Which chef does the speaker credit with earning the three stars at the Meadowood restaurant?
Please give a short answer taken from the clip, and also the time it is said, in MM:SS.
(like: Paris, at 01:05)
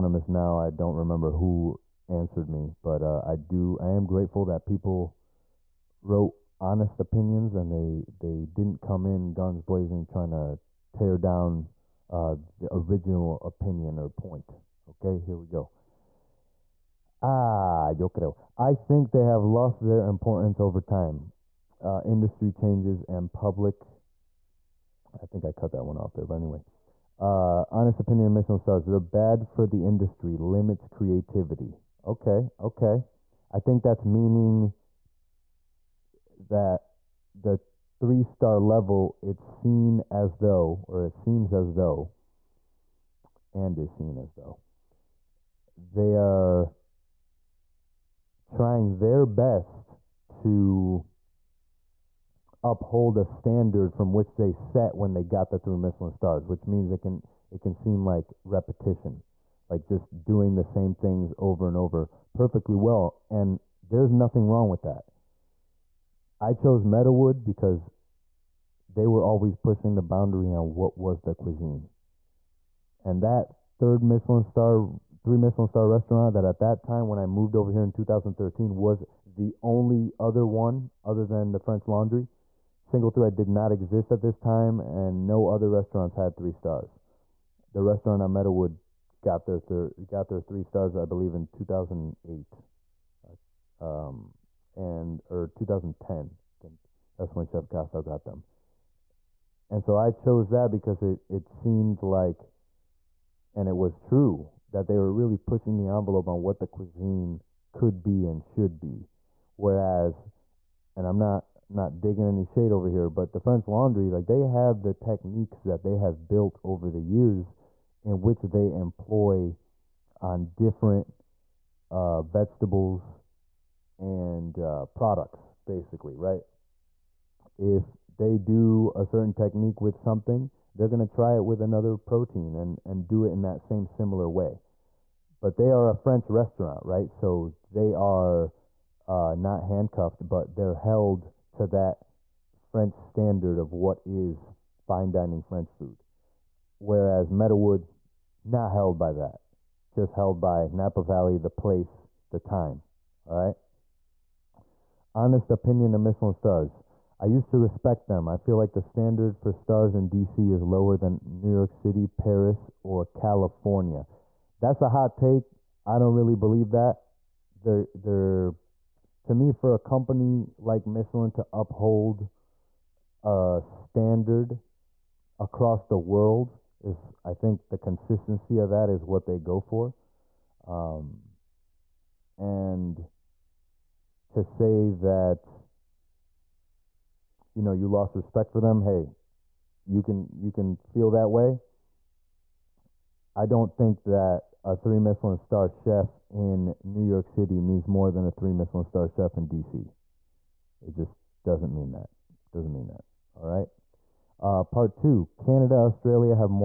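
Chef Kostow, at 01:37.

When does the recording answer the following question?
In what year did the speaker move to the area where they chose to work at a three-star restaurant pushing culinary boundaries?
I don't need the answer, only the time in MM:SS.
01:17.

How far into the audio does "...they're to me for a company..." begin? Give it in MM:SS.
02:47.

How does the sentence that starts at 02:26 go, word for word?
Whereas Meadowood, not held by that, just held by Napa Valley, the place, the time.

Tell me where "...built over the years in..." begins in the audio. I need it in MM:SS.
01:56.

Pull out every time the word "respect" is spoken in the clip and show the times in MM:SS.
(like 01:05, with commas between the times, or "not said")
02:37, 03:08.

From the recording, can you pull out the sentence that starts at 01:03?
And there's nothing wrong with that.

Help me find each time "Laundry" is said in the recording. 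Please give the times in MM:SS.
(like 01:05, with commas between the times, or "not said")
01:21, 01:53.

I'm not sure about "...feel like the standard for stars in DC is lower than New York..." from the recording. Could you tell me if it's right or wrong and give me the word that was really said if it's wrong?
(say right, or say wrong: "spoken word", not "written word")
right.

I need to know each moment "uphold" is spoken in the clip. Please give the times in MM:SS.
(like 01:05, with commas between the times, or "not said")
00:52, 02:51.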